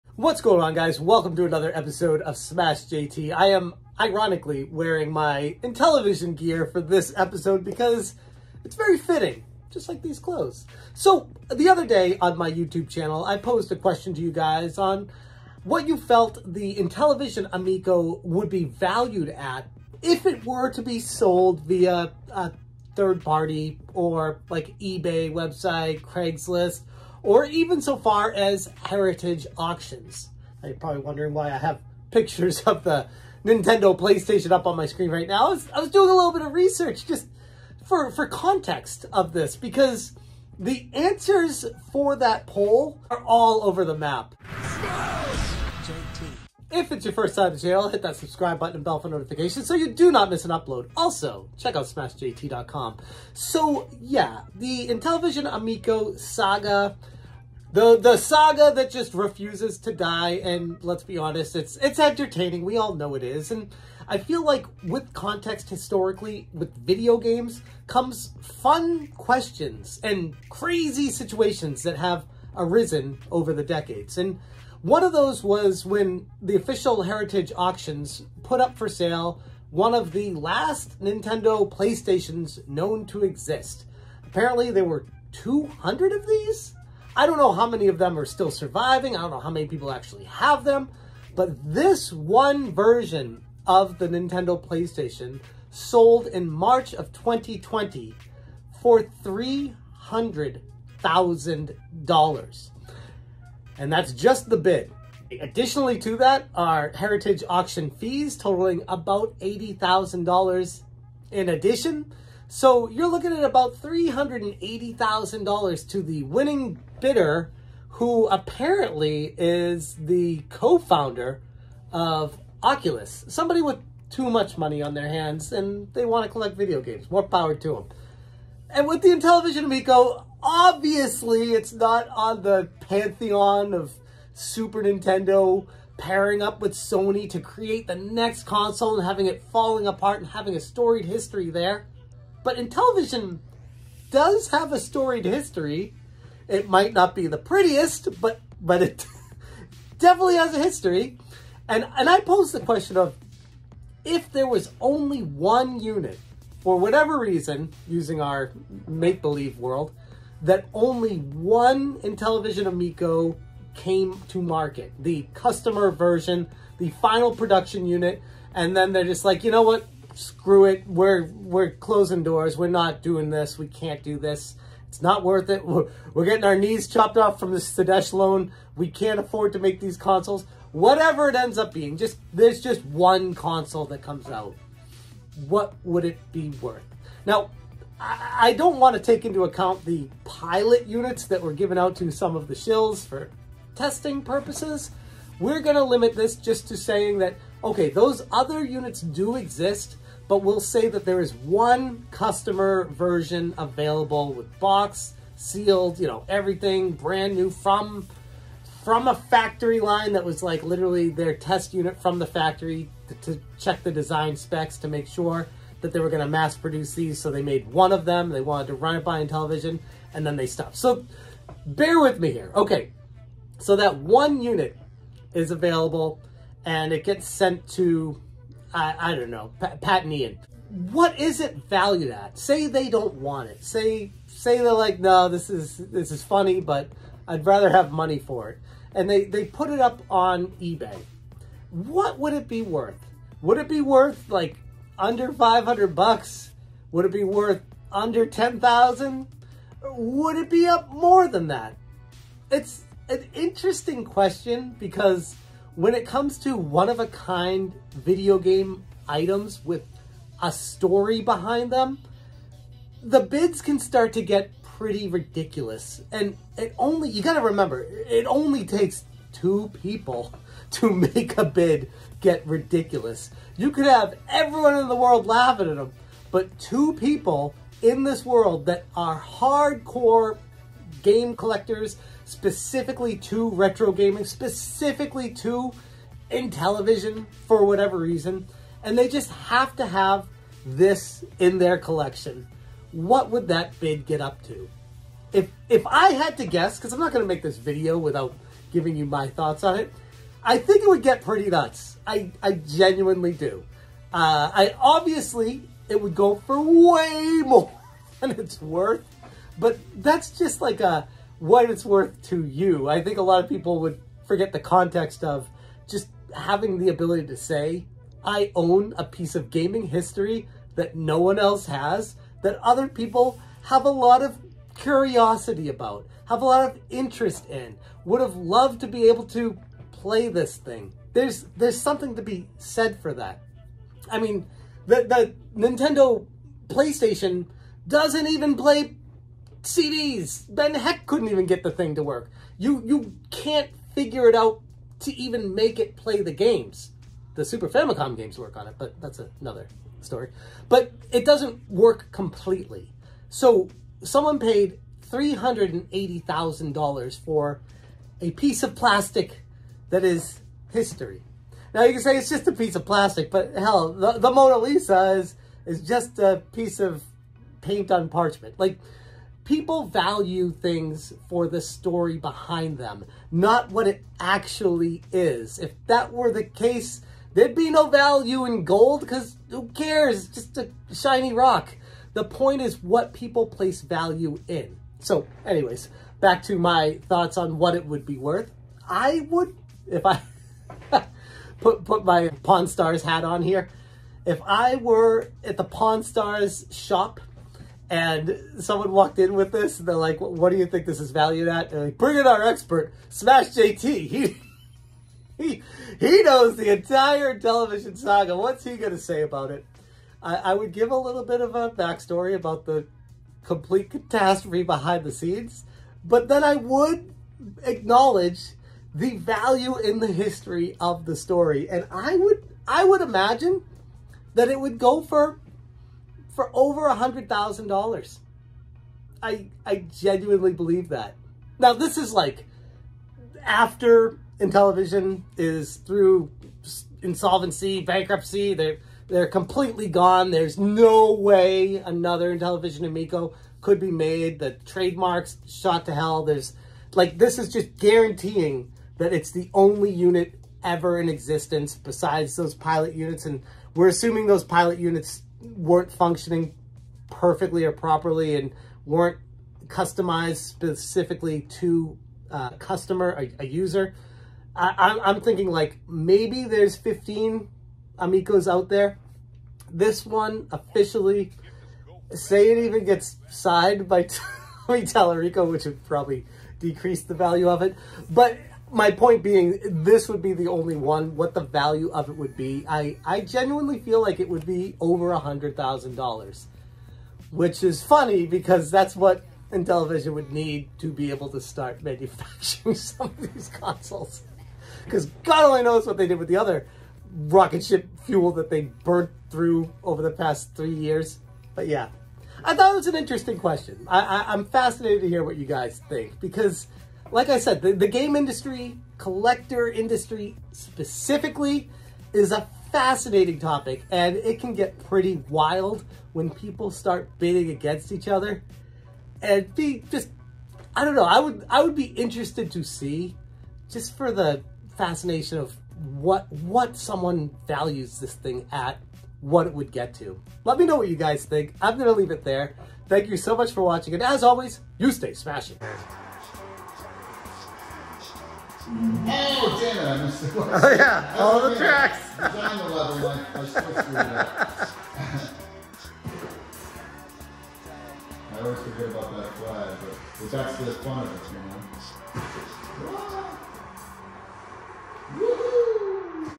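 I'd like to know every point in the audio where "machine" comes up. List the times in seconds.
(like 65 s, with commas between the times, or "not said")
not said.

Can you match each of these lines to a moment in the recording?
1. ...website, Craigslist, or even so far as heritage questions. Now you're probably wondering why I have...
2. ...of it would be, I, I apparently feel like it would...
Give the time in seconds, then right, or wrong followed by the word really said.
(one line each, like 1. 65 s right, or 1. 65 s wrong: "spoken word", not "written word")
1. 25 s wrong: "auctions", not "questions"
2. 481 s wrong: "genuinely", not "apparently".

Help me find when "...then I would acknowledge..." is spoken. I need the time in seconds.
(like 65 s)
416 s.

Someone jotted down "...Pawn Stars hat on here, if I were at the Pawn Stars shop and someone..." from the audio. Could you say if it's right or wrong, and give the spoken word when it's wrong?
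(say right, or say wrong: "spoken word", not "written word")
right.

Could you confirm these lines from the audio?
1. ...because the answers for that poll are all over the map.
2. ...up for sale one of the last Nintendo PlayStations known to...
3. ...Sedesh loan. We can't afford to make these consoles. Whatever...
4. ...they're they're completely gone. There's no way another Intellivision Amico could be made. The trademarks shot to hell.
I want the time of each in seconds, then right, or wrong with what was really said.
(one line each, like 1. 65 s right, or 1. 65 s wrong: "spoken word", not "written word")
1. 39 s right
2. 78 s right
3. 177 s right
4. 438 s right.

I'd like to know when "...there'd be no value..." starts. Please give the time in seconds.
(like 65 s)
377 s.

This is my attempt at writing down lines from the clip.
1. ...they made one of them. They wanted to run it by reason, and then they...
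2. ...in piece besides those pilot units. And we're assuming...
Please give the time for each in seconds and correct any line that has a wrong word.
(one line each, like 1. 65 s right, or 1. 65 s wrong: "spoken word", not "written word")
1. 217 s wrong: "television", not "reason"
2. 451 s wrong: "existence", not "piece".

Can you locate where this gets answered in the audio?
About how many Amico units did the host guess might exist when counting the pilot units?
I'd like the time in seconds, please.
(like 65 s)
466 s.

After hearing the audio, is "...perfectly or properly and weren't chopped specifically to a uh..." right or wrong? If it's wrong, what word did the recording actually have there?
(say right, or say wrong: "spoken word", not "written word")
wrong: "customized", not "chopped".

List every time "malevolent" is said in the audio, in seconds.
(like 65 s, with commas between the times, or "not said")
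not said.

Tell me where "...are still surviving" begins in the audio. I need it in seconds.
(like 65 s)
88 s.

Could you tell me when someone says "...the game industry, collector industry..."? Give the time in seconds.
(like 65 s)
507 s.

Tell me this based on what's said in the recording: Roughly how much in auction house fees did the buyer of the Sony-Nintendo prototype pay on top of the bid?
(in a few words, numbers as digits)
$80,000.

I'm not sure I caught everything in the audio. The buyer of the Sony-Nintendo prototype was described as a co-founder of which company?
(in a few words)
Oculus.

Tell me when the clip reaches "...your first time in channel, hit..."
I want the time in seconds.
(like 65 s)
47 s.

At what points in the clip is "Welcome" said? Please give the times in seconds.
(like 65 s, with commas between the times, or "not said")
0 s.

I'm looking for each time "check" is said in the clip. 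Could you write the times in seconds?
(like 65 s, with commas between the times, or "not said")
51 s, 213 s.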